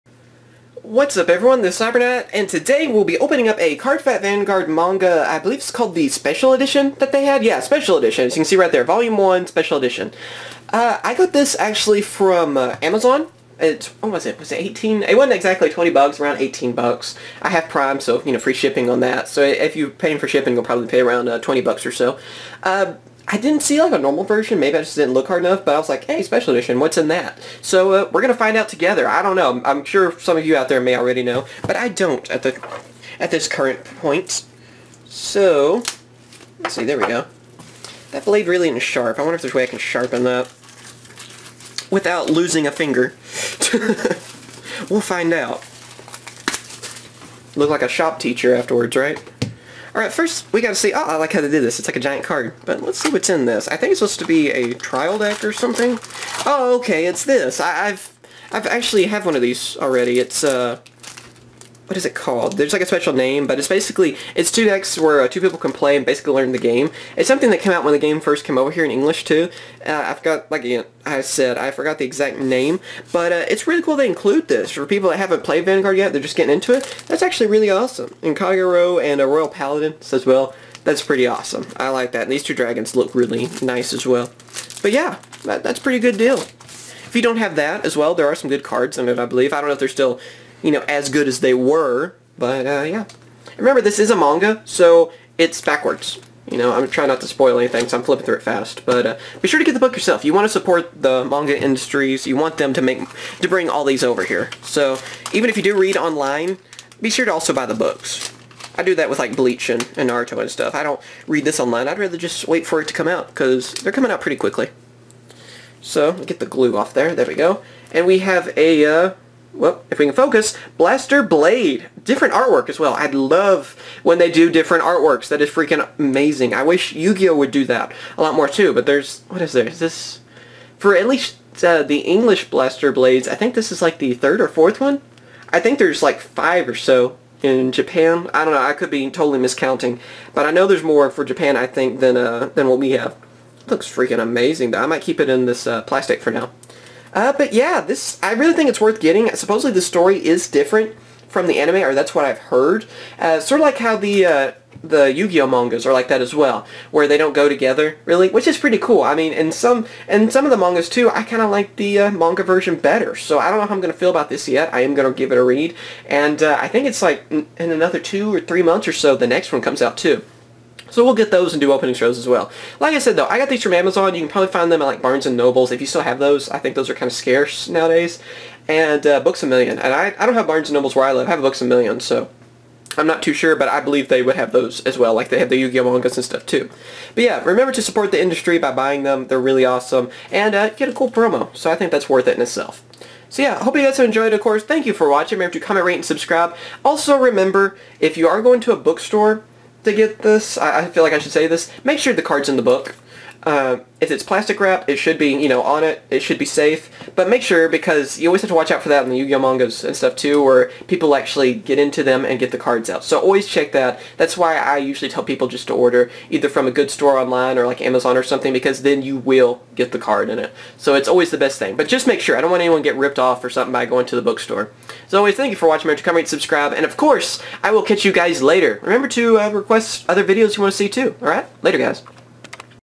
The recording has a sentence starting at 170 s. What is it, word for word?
So we'll get those and do opening shows as well.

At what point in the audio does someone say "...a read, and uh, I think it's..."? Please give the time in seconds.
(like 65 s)
165 s.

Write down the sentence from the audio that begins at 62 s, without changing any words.
There's like a special name, but it's basically, it's 2 decks where uh, two people can play and basically learn the game.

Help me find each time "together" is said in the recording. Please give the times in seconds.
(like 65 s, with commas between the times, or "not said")
28 s, 157 s.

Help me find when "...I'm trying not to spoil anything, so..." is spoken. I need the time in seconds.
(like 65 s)
96 s.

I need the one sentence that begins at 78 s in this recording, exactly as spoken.
And Kagero and a uh, Royal Paladin as well, that's pretty awesome.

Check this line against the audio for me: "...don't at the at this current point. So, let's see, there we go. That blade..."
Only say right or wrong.
right.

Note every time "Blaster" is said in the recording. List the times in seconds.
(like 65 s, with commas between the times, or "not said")
120 s, 132 s.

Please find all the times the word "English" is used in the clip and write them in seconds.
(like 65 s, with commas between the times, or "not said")
68 s, 131 s.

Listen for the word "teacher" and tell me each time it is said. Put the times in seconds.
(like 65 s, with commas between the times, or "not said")
48 s.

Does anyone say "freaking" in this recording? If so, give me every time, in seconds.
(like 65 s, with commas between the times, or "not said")
125 s, 143 s.